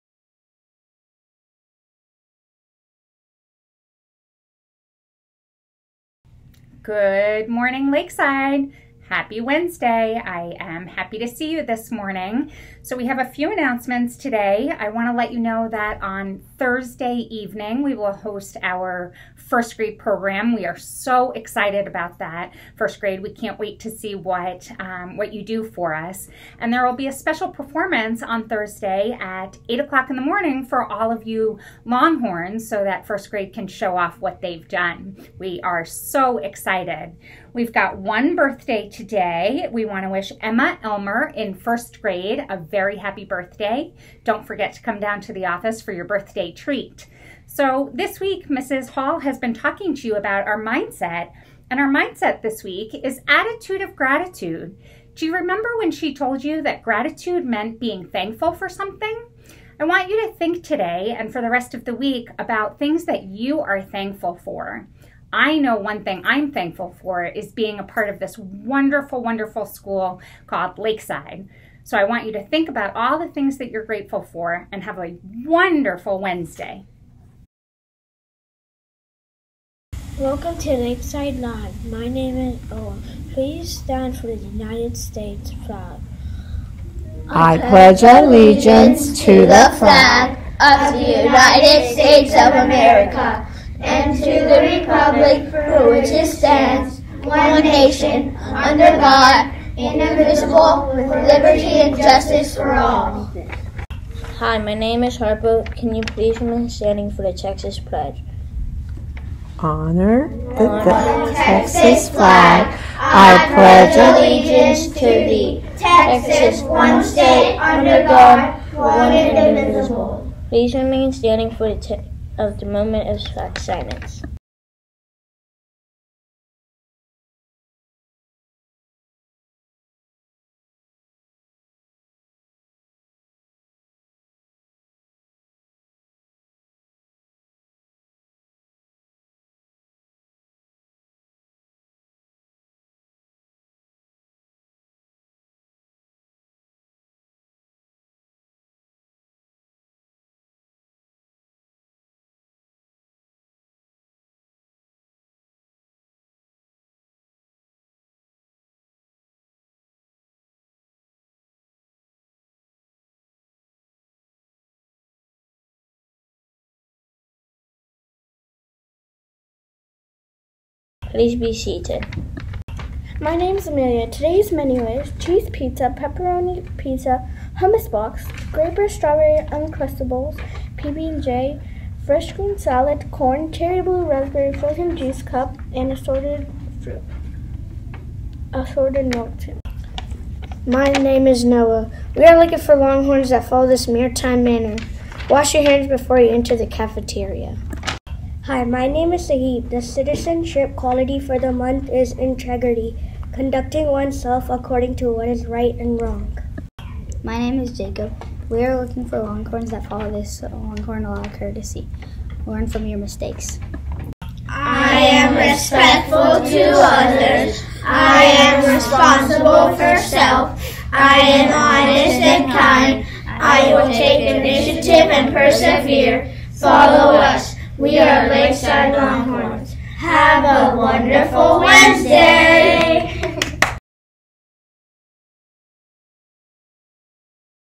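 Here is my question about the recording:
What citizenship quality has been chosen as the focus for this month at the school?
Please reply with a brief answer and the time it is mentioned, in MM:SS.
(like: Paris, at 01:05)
integrity, at 03:22.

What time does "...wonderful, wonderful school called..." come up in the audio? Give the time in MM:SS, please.
01:08.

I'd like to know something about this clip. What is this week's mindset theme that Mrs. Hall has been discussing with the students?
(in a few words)
attitude of gratitude.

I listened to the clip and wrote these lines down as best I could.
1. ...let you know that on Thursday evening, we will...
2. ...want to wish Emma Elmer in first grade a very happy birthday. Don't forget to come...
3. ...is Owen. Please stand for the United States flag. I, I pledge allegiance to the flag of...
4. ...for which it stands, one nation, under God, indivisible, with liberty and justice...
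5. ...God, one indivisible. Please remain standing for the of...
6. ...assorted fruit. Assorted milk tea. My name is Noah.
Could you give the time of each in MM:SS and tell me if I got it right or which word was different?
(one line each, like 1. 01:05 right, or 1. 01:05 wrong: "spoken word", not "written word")
1. 00:15 right
2. 00:39 right
3. 01:22 right
4. 01:35 right
5. 01:58 right
6. 03:05 right.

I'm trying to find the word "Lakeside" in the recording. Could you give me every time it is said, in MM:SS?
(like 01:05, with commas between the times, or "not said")
00:07, 01:10, 01:20, 03:48.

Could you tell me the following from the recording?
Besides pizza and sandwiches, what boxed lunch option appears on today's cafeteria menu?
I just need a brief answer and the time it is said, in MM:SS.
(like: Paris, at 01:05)
hummus box, at 02:57.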